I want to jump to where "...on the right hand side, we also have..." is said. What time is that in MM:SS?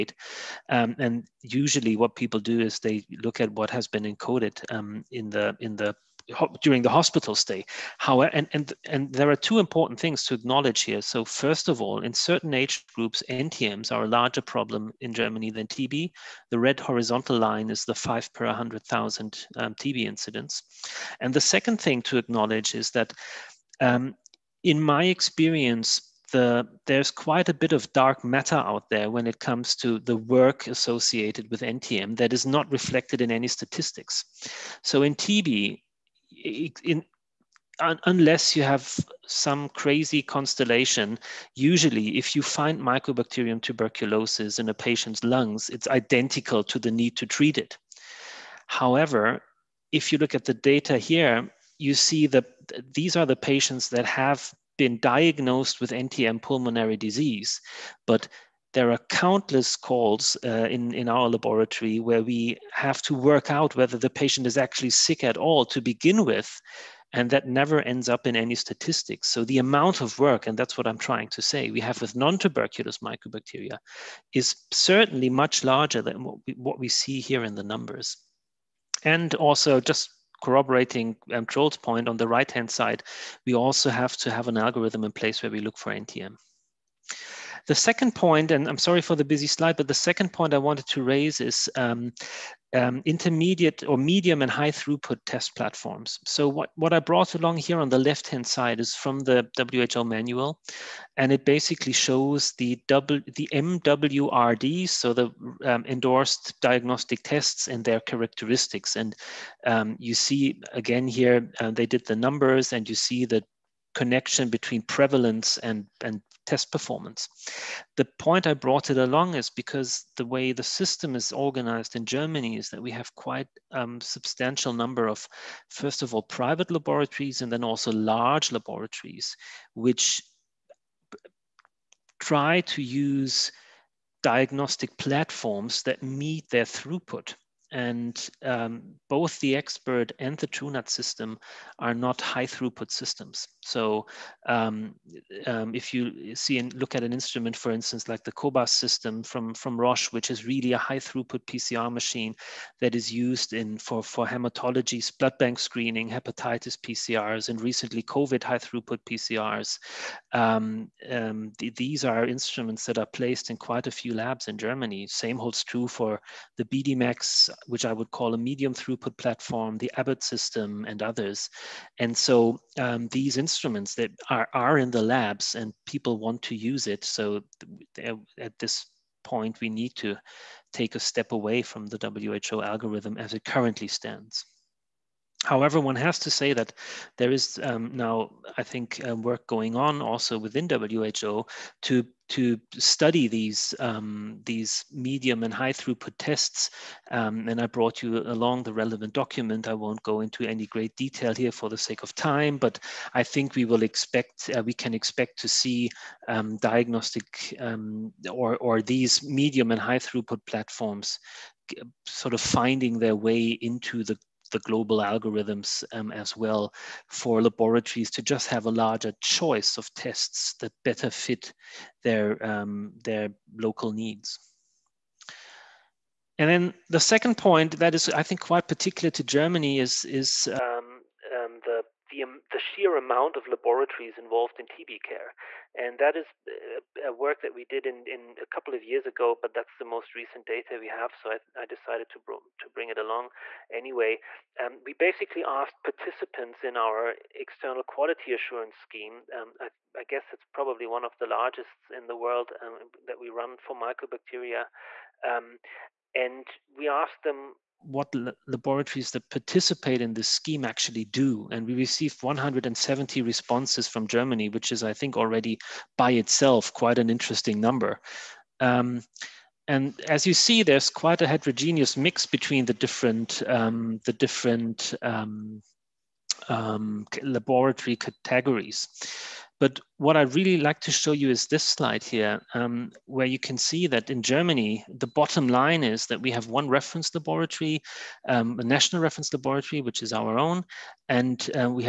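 01:22.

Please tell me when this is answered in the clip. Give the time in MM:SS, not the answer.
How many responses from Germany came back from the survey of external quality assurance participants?
04:22.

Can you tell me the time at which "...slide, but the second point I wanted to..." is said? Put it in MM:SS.
01:29.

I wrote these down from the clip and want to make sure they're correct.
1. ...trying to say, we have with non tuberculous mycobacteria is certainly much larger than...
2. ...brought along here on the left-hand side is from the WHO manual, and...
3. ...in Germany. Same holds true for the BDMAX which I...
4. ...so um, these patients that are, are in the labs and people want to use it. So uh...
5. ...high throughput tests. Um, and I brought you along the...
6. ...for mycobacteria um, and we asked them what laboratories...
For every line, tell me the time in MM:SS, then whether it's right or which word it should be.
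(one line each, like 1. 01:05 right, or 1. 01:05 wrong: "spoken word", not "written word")
1. 01:10 right
2. 01:37 right
3. 02:44 right
4. 02:52 wrong: "instruments", not "patients"
5. 03:15 right
6. 04:13 right.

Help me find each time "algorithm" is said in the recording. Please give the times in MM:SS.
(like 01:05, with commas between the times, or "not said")
01:24, 03:02, 03:34.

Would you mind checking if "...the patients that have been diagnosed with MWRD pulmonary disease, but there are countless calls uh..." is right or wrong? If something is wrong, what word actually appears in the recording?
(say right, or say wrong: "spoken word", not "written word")
wrong: "NTM", not "MWRD".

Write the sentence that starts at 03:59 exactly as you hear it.
But that's the most recent data we have, so I, I decided to to bring it along anyway.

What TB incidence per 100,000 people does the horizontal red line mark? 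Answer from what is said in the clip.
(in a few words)
5.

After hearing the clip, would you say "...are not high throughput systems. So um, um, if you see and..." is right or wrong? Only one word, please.
right.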